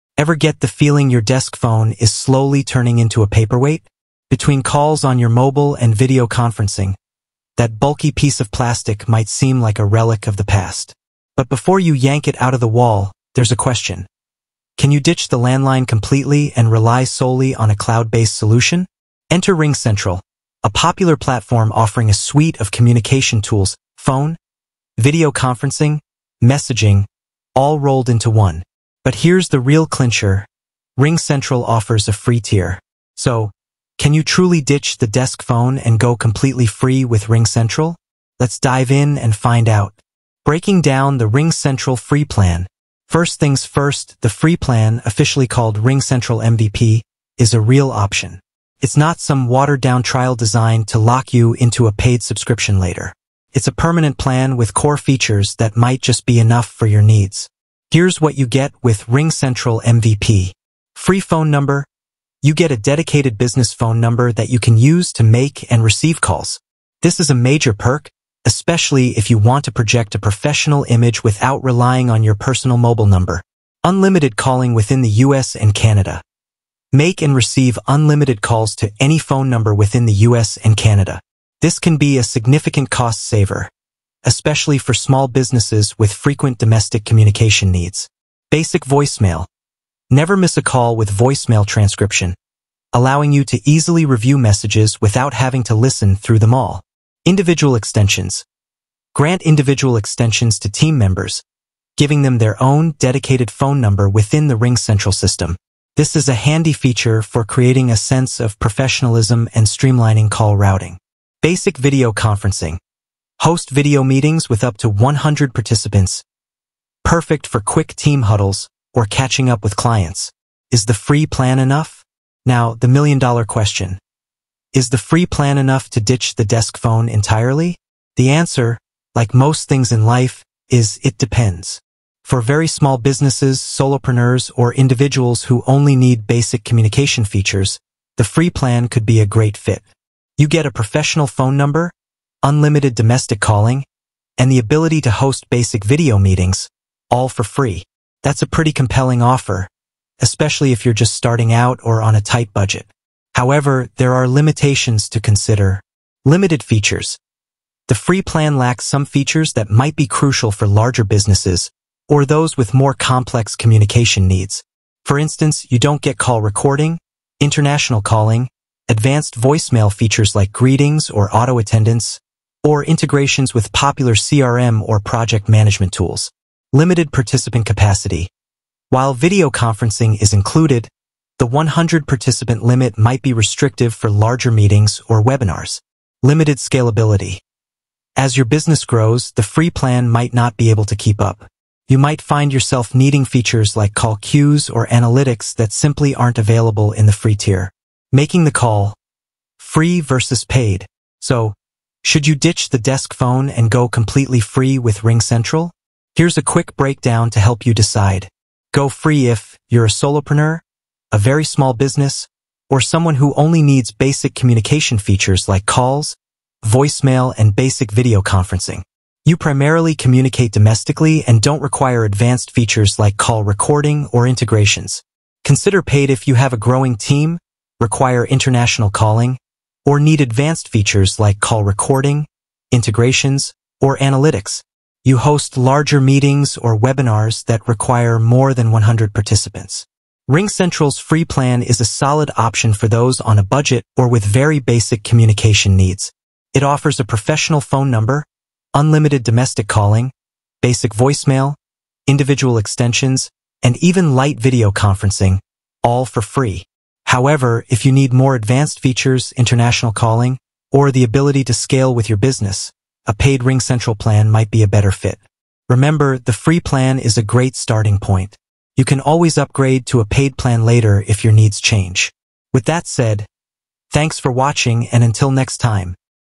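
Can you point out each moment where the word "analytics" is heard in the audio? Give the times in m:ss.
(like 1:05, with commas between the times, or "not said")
3:14, 3:53.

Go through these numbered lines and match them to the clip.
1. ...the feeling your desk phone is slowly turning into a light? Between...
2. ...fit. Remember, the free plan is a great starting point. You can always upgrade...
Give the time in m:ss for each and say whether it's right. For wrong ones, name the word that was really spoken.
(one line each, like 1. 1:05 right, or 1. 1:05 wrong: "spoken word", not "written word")
1. 0:00 wrong: "paperweight", not "light"
2. 4:24 right.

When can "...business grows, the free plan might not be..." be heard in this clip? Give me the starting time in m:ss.
3:08.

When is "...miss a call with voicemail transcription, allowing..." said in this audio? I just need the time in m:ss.
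1:30.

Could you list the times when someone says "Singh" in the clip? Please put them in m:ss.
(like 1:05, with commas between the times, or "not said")
not said.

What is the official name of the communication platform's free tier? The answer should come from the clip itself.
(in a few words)
RingCentral MVP.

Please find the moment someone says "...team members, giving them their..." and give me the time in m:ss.
1:40.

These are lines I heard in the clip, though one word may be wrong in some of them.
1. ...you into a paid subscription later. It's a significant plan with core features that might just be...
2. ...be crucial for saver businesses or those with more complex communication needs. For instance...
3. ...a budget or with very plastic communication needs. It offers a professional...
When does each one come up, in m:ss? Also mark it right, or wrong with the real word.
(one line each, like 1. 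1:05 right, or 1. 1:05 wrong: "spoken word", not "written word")
1. 0:51 wrong: "permanent", not "significant"
2. 2:39 wrong: "larger", not "saver"
3. 4:03 wrong: "basic", not "plastic".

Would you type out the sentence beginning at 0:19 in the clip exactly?
Enter RingCentral, a popular platform offering a suite of communication tools, phone, video conferencing, messaging, all rolled into one.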